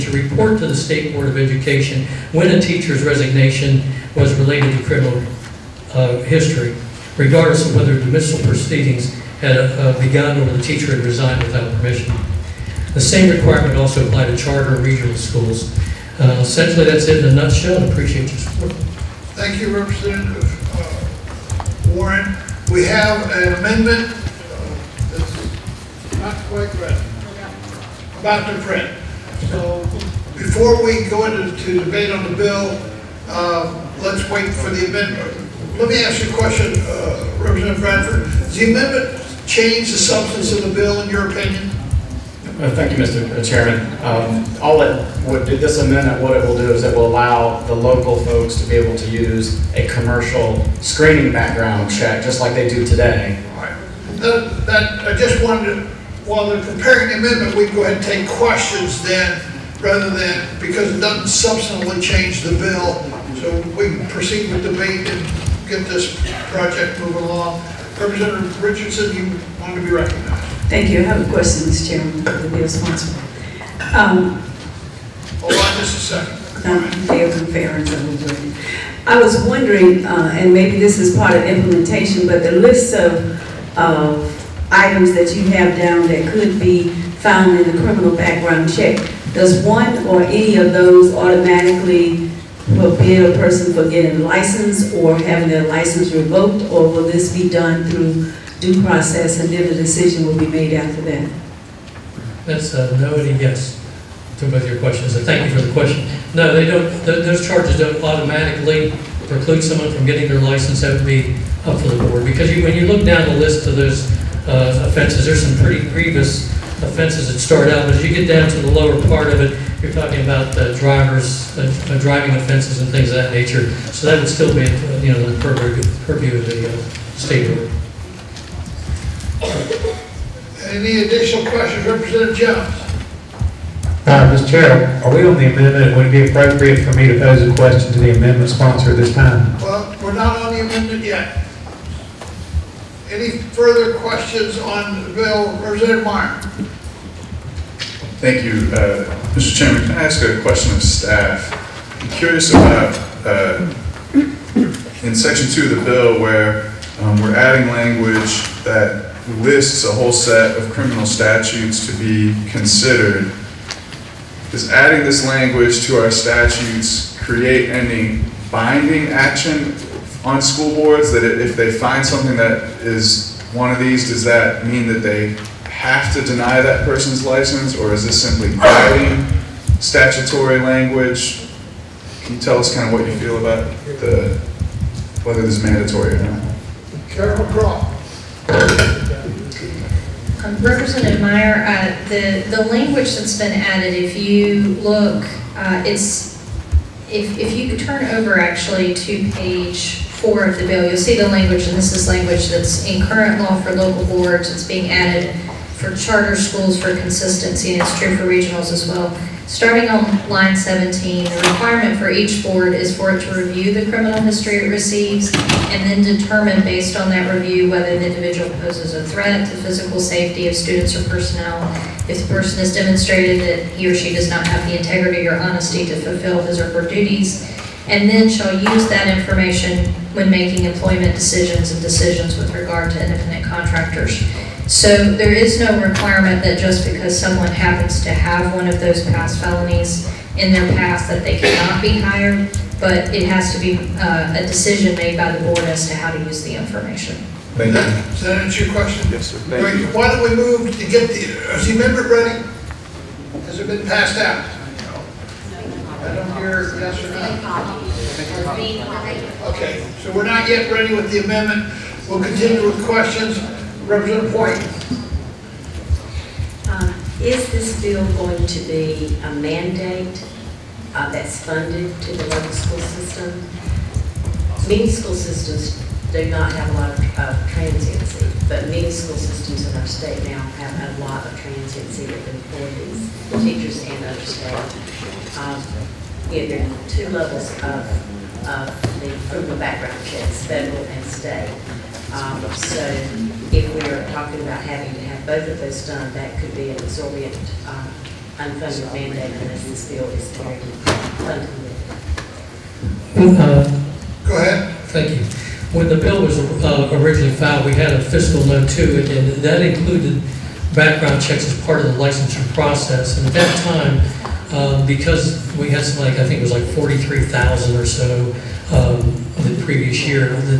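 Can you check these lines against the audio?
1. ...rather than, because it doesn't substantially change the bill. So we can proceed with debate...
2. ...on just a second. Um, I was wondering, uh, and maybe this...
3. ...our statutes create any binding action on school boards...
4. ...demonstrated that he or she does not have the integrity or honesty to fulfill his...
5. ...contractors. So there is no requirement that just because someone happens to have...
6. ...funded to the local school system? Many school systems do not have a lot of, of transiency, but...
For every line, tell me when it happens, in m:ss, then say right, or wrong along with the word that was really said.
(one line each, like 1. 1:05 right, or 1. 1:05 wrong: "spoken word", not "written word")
1. 0:59 right
2. 1:15 right
3. 2:46 right
4. 3:42 right
5. 3:53 right
6. 4:31 right.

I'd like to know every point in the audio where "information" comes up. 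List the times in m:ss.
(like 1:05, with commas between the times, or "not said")
3:49, 4:06.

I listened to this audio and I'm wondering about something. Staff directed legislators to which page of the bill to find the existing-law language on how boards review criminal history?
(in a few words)
page 4.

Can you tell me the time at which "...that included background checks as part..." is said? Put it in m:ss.
5:09.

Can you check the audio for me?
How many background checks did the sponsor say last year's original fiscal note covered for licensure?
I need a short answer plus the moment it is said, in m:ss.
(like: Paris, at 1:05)
43,000, at 5:16.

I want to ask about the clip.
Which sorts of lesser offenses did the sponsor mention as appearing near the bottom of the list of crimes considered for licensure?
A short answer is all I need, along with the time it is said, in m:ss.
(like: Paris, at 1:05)
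driving offenses, at 2:01.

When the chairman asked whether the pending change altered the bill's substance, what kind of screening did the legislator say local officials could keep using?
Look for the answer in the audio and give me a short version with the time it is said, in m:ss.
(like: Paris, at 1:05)
commercial screening background check, at 0:49.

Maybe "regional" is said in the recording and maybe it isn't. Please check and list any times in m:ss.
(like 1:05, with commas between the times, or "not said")
0:14, 3:28.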